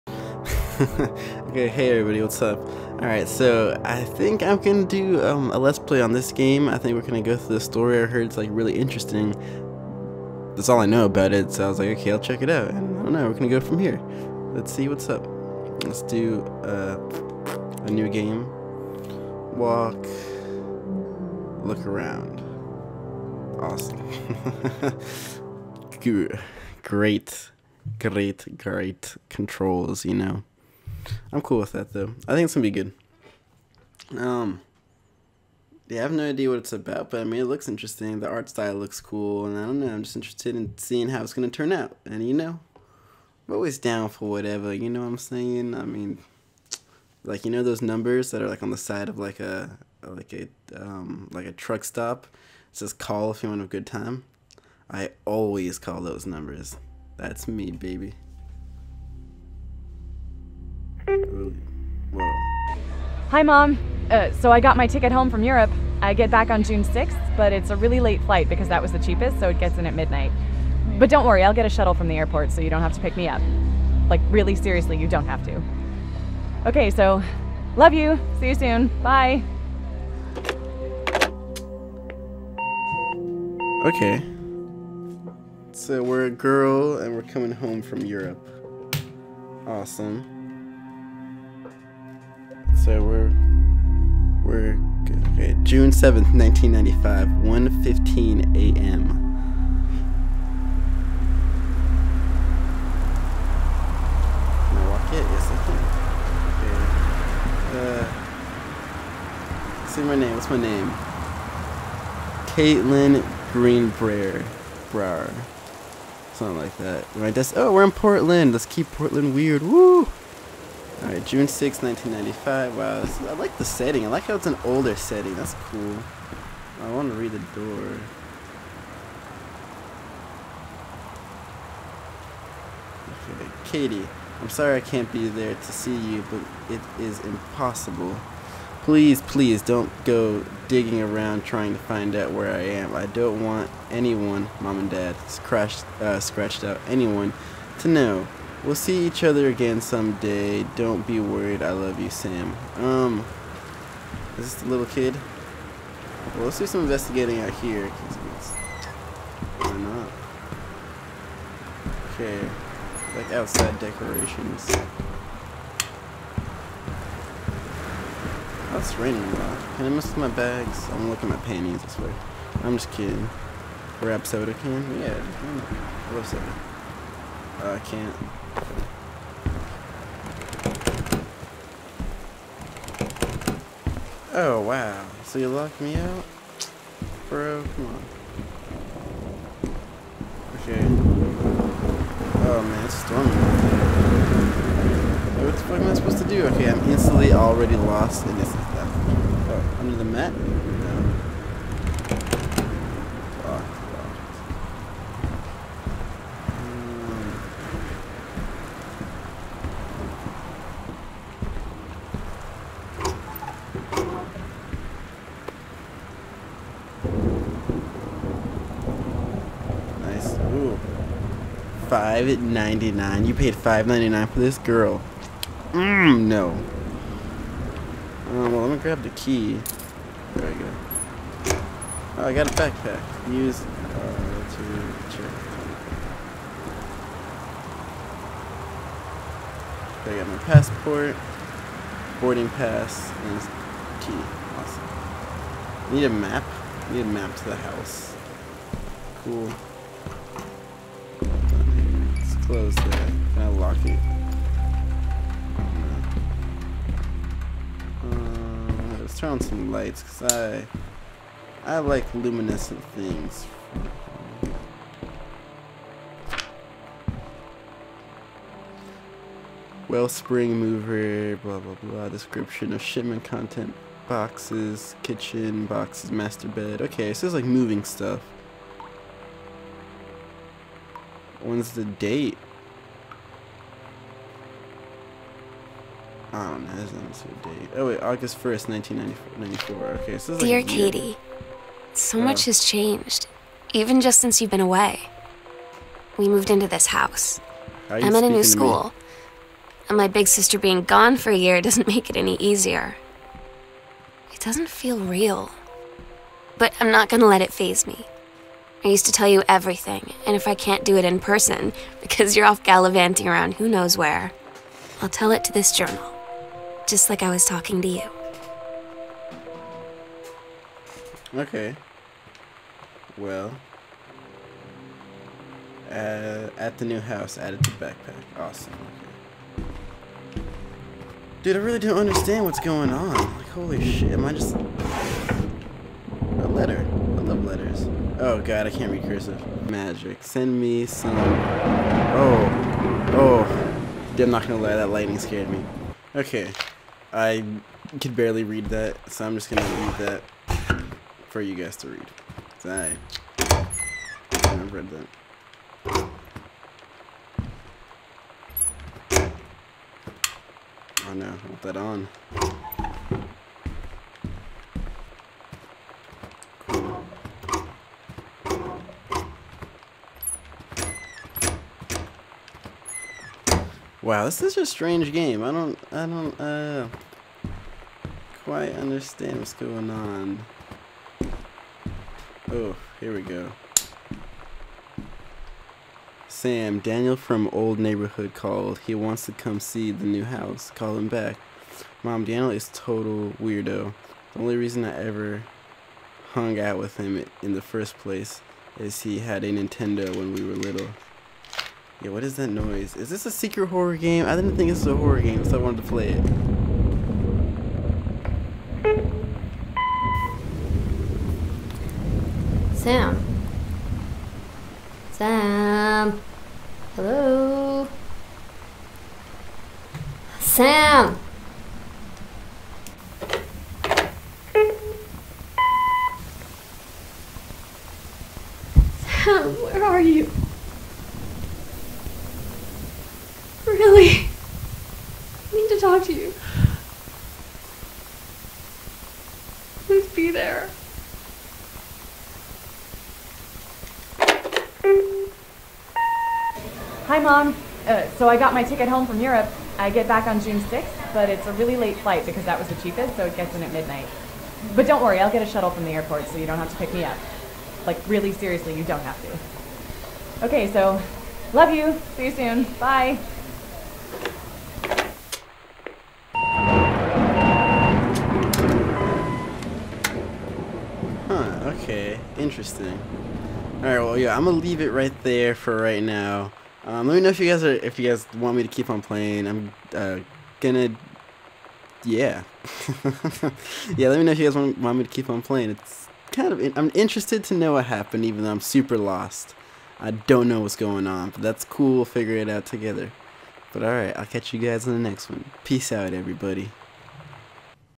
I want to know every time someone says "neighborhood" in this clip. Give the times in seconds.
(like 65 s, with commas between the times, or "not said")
387 s.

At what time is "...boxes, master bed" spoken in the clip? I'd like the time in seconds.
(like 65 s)
275 s.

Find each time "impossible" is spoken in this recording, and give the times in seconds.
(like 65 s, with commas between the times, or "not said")
137 s.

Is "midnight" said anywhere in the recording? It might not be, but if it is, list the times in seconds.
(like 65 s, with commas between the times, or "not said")
69 s, 453 s.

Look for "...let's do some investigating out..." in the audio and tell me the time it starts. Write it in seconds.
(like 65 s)
156 s.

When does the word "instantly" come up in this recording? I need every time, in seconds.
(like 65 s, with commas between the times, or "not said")
196 s.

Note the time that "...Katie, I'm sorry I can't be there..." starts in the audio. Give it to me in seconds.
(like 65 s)
133 s.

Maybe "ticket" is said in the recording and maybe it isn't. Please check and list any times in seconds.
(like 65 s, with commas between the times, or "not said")
64 s, 448 s.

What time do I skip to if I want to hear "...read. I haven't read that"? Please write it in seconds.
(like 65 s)
351 s.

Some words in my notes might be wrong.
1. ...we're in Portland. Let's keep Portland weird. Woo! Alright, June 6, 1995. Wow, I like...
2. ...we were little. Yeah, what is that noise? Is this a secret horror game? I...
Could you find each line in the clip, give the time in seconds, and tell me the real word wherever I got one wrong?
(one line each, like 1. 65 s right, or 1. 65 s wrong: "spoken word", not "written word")
1. 117 s right
2. 400 s right.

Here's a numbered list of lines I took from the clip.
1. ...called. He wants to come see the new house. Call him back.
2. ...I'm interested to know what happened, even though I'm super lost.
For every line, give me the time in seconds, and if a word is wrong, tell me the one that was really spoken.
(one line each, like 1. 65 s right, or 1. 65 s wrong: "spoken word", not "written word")
1. 388 s right
2. 486 s right.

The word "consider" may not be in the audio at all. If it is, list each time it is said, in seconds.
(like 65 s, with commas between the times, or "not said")
not said.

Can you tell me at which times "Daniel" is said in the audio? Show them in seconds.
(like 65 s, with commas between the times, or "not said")
386 s, 392 s.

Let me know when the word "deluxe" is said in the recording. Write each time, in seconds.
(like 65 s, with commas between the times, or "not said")
not said.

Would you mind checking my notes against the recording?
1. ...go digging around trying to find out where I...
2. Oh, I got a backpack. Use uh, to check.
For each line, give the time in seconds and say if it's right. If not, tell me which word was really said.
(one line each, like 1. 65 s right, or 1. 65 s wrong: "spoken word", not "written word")
1. 140 s right
2. 232 s right.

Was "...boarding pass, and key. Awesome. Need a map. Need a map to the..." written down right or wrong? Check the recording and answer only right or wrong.
right.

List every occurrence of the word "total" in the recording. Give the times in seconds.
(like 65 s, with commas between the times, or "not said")
392 s.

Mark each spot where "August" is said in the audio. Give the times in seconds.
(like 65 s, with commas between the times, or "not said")
288 s.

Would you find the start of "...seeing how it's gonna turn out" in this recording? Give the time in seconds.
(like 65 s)
40 s.